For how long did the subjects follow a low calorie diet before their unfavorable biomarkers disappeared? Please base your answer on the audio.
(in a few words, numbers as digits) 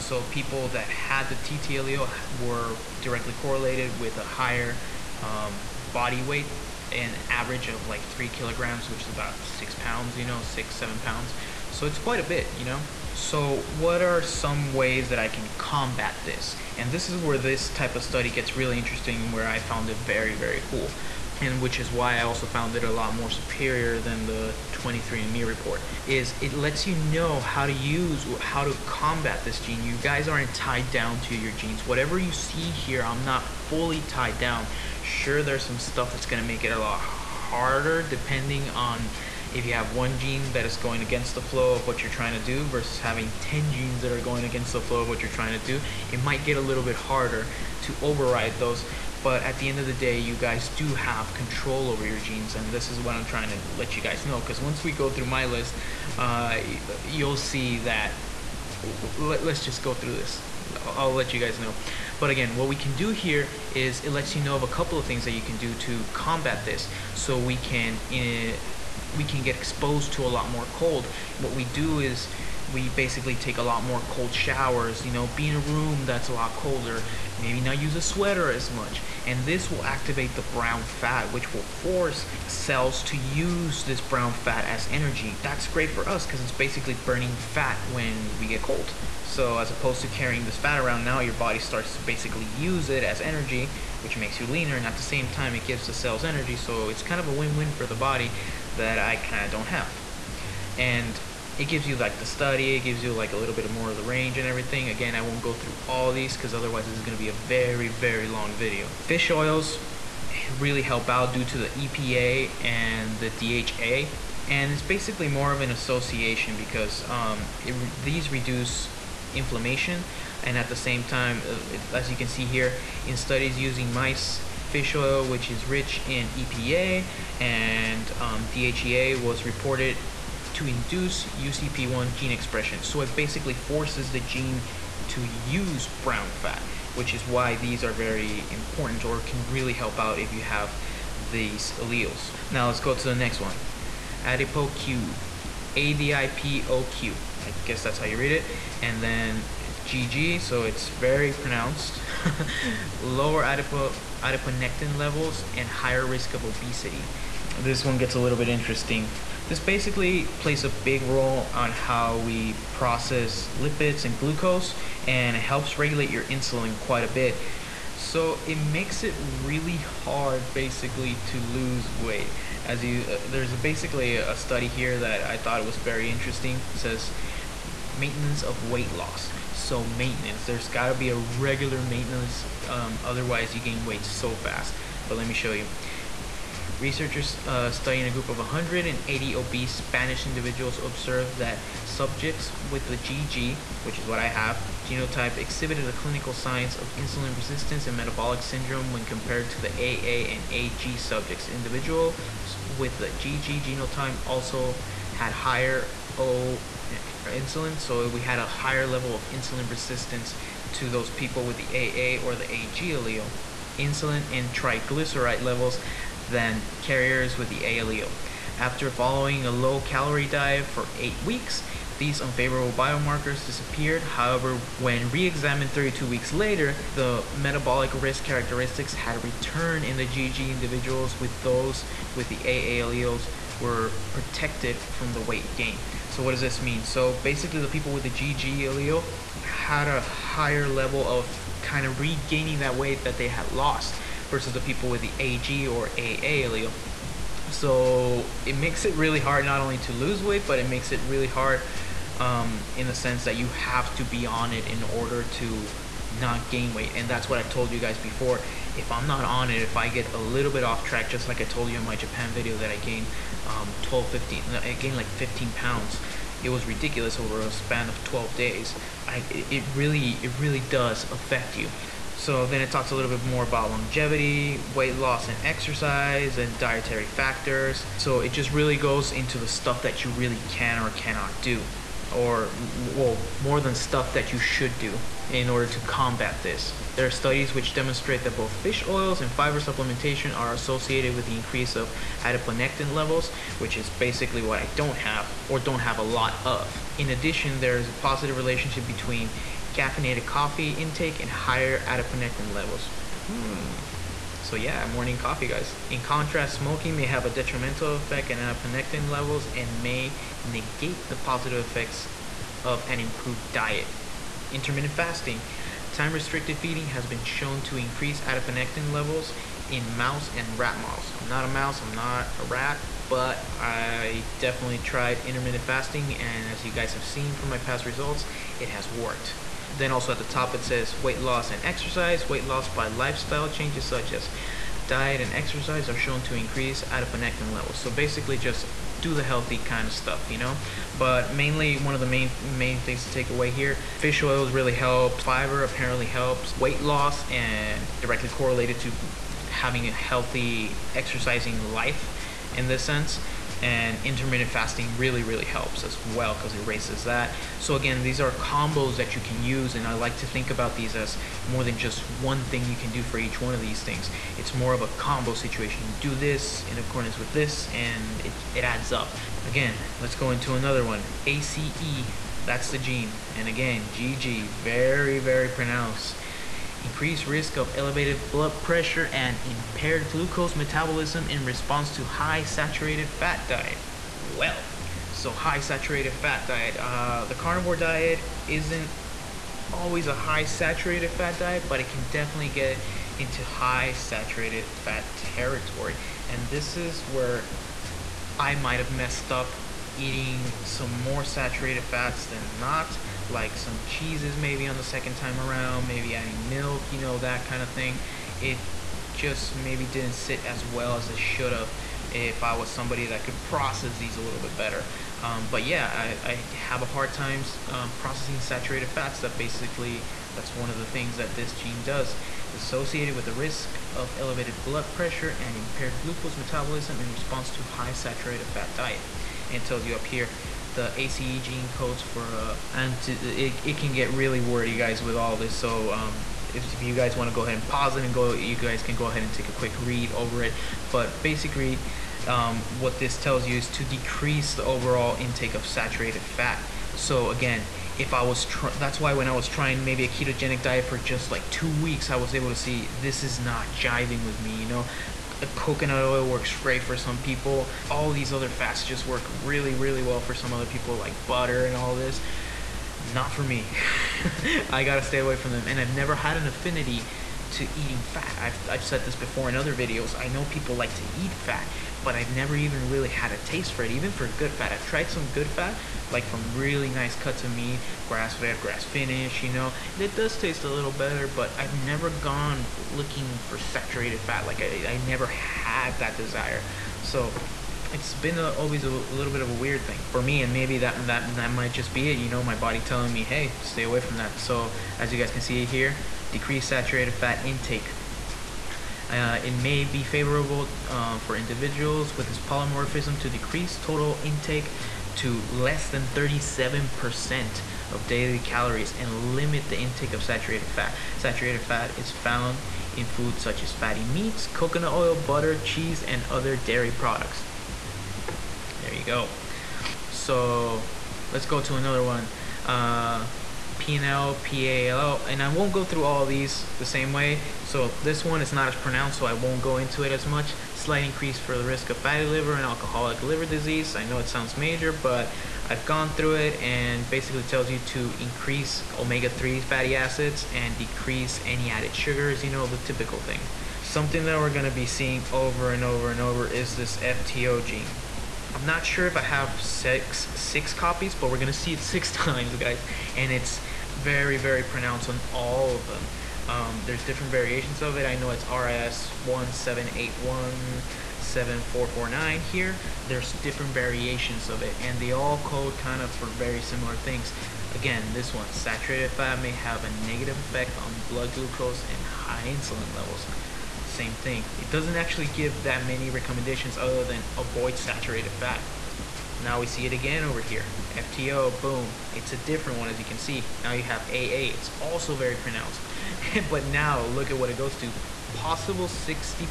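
8 weeks.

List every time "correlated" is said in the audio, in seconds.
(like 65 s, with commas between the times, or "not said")
3 s, 348 s.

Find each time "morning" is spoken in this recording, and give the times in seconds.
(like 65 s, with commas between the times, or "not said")
304 s.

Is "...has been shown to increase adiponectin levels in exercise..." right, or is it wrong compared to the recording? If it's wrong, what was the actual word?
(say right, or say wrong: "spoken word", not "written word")
wrong: "mouse", not "exercise".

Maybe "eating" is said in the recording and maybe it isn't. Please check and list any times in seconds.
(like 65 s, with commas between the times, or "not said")
399 s, 467 s.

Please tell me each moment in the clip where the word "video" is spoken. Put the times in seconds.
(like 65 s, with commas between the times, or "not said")
108 s, 262 s, 469 s.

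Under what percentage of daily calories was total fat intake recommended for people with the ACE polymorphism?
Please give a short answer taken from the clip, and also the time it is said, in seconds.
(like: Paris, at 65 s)
37%, at 506 s.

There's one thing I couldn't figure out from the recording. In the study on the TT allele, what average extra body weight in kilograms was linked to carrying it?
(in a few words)
3 kilograms.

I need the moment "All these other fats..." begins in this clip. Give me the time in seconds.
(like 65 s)
457 s.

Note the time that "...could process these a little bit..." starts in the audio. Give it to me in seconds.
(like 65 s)
413 s.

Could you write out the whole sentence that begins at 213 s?
Insulin and triglyceride levels than carriers with the A allele.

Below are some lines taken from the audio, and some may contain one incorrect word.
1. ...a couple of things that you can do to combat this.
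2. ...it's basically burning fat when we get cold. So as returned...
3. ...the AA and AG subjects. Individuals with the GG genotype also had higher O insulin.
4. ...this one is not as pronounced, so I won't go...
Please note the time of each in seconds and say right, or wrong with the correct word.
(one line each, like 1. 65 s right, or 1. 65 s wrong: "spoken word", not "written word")
1. 64 s right
2. 86 s wrong: "opposed", not "returned"
3. 199 s right
4. 528 s right.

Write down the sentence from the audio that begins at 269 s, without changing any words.
I, it really, it really does affect you.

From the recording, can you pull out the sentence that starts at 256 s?
And that's what I've told you guys before.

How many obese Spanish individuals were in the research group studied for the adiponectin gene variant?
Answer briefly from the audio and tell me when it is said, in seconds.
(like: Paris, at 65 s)
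180, at 188 s.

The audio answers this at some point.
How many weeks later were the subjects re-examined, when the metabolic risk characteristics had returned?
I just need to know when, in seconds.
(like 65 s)
225 s.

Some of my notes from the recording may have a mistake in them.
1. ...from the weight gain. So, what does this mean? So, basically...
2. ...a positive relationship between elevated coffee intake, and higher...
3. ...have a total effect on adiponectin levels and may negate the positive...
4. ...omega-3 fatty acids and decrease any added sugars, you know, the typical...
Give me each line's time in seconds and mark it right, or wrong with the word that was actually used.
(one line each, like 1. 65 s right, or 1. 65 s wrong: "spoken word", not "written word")
1. 234 s right
2. 297 s wrong: "caffeinated", not "elevated"
3. 307 s wrong: "detrimental", not "total"
4. 538 s right.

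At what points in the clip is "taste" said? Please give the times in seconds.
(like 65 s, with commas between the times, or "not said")
473 s, 480 s.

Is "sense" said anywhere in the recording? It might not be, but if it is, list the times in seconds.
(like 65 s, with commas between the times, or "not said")
252 s, 352 s.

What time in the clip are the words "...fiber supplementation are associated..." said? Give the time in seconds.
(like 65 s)
289 s.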